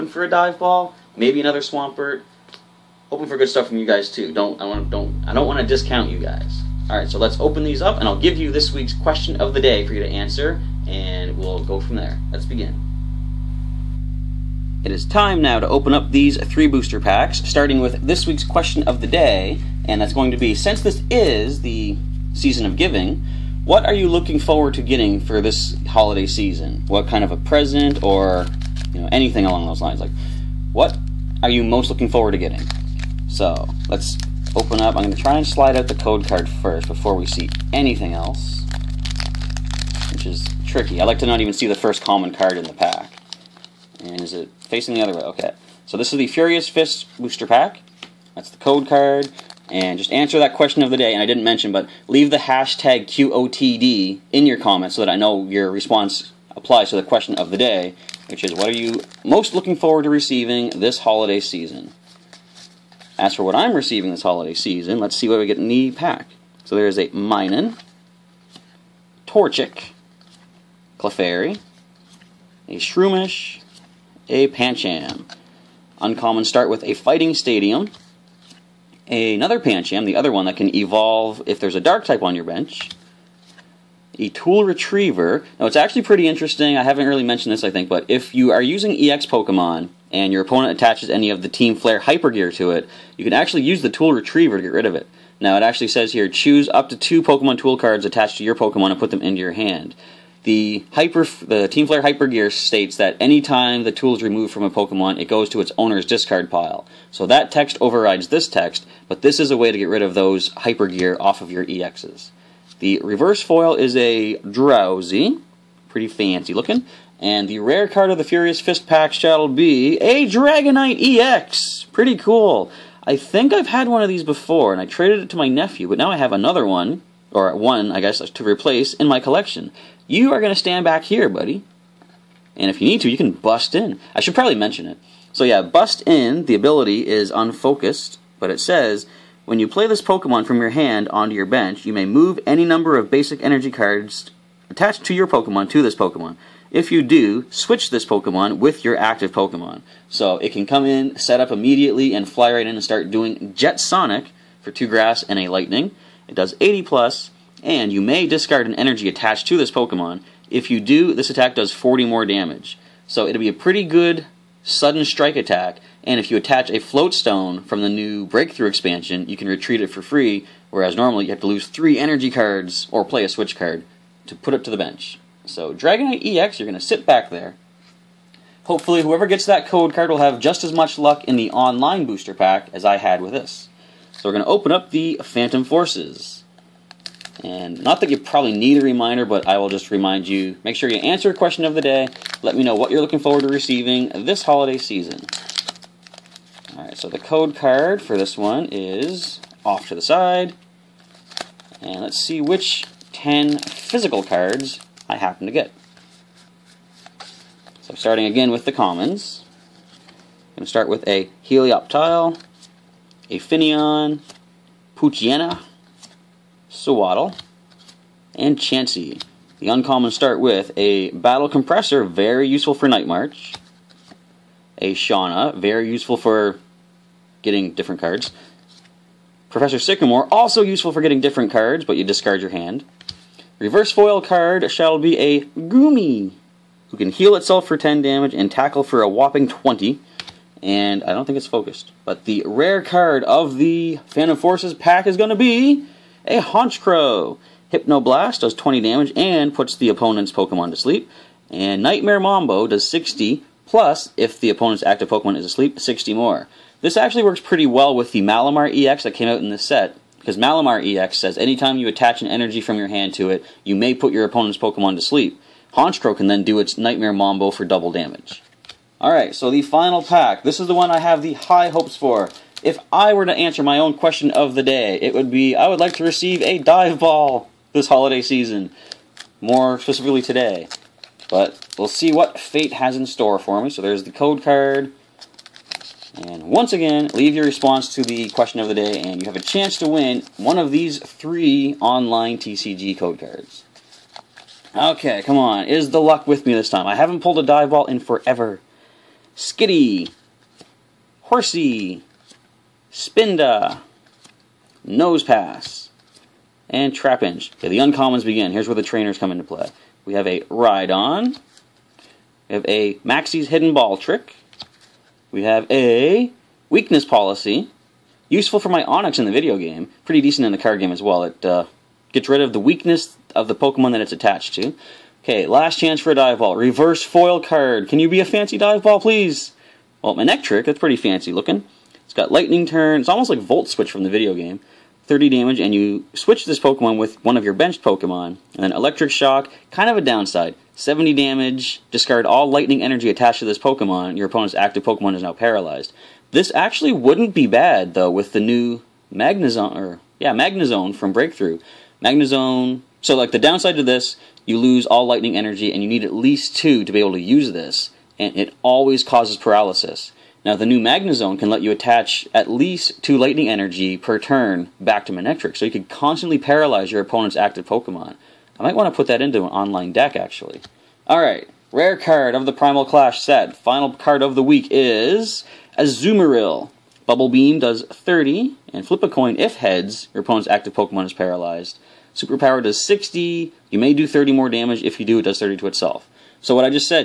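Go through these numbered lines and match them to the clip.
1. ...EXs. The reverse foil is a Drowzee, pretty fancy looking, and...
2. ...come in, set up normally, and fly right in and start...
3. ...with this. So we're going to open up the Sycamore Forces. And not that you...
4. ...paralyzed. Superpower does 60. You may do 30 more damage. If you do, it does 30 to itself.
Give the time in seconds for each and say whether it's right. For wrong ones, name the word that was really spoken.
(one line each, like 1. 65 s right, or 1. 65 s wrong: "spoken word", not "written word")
1. 111 s right
2. 150 s wrong: "immediately", not "normally"
3. 183 s wrong: "Phantom", not "Sycamore"
4. 381 s right.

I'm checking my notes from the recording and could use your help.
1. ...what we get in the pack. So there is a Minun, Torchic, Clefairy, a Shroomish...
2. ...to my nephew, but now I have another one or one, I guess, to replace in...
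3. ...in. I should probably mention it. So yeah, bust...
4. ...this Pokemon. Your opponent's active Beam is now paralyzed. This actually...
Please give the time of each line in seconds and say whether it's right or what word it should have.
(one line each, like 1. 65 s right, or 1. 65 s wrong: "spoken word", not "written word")
1. 65 s right
2. 125 s right
3. 133 s right
4. 343 s wrong: "Pokemon", not "Beam".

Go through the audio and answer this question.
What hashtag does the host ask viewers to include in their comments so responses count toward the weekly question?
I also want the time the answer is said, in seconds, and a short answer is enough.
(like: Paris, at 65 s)
QOTD, at 53 s.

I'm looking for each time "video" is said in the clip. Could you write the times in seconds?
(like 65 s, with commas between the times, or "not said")
319 s, 334 s.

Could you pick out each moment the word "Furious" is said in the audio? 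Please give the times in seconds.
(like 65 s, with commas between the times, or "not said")
46 s, 118 s.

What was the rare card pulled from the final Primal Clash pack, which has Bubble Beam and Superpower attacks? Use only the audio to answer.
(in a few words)
Azumarill.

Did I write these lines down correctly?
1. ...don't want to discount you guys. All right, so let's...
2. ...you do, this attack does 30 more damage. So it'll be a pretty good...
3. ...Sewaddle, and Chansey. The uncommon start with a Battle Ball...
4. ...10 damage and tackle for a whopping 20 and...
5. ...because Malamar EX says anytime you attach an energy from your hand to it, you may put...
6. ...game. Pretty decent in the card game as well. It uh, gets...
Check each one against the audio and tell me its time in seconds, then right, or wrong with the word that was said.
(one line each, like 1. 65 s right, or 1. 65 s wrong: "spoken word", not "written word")
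1. 5 s right
2. 160 s wrong: "40", not "30"
3. 216 s wrong: "Compressor", not "Ball"
4. 237 s right
5. 260 s right
6. 319 s right.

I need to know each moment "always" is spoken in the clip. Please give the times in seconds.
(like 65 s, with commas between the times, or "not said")
358 s.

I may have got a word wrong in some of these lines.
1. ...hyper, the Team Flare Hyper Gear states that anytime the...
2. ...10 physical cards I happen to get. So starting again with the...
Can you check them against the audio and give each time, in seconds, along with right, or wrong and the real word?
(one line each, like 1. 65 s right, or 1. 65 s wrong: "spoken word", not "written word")
1. 100 s right
2. 203 s right.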